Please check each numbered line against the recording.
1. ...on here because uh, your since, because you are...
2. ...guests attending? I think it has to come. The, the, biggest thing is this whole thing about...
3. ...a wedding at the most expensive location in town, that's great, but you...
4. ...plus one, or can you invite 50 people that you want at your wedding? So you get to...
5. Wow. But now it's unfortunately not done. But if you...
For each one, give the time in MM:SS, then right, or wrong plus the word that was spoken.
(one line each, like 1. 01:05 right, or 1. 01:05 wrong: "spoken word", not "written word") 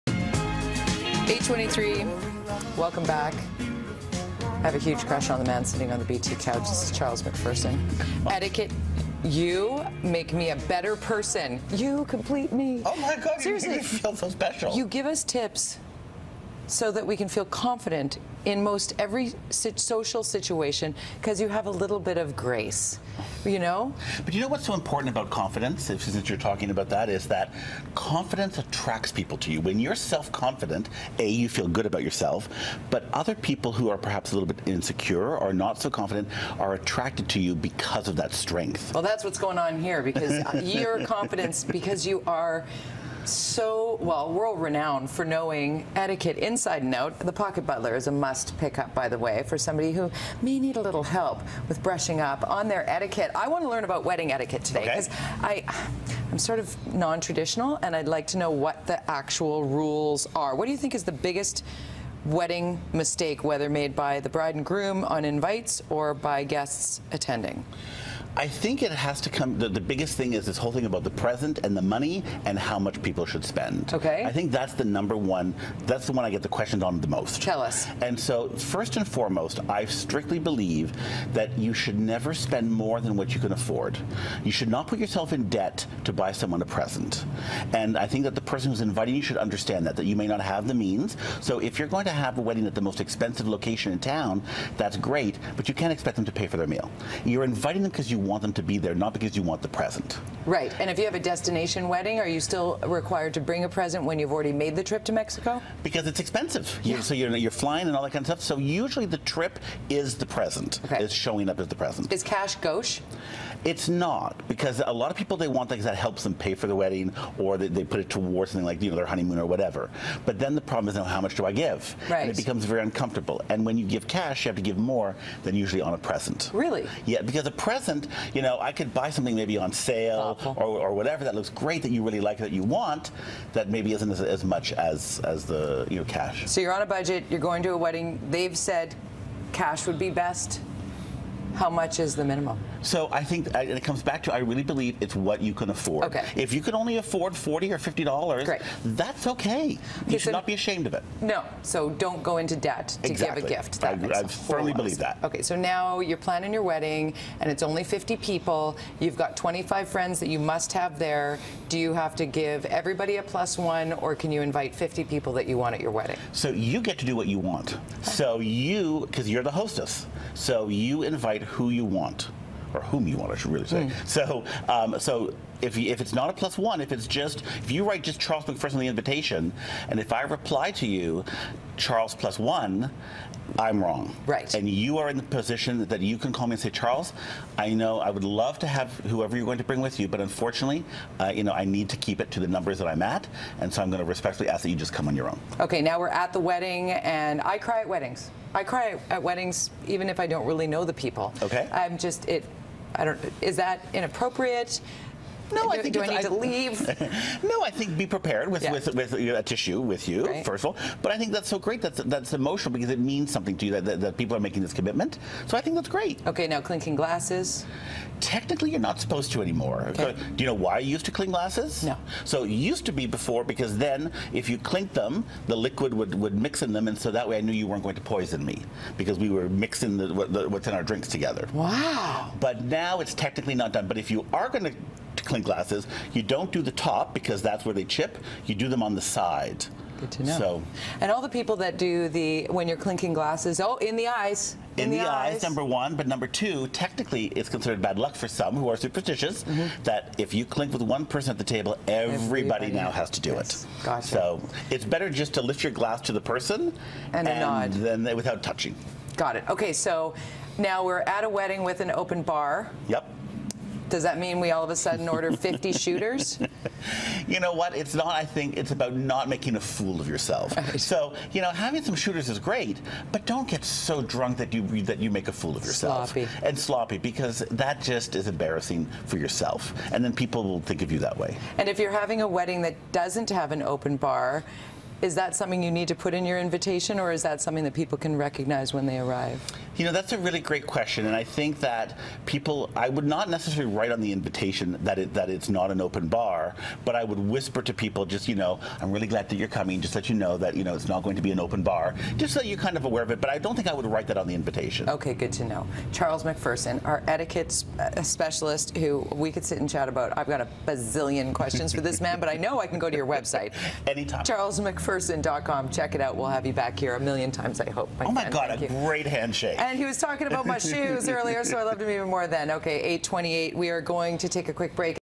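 1. 00:39 wrong: "confidence", not "since"
2. 01:06 right
3. 01:32 right
4. 02:43 right
5. 03:51 wrong: "technically", not "unfortunately".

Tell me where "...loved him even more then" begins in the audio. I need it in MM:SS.
05:21.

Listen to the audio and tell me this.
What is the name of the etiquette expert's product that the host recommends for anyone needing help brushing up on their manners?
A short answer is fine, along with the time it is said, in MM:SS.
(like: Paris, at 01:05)
The Pocket Butler, at 00:47.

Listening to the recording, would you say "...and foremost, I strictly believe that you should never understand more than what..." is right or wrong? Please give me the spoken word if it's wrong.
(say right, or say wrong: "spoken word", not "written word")
wrong: "spend", not "understand".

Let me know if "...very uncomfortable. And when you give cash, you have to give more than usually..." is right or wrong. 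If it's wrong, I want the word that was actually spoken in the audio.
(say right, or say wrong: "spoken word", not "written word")
right.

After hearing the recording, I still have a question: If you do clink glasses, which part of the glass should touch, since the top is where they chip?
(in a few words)
The side.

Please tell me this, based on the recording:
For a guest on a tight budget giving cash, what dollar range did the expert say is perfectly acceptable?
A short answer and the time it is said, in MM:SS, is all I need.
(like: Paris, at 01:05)
$40 or $50, at 02:27.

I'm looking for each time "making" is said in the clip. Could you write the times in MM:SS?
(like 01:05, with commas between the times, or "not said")
03:34, 04:29.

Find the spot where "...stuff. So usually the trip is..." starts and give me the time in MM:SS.
01:48.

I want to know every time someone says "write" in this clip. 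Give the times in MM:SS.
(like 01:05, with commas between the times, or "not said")
02:57, 04:53, 05:03.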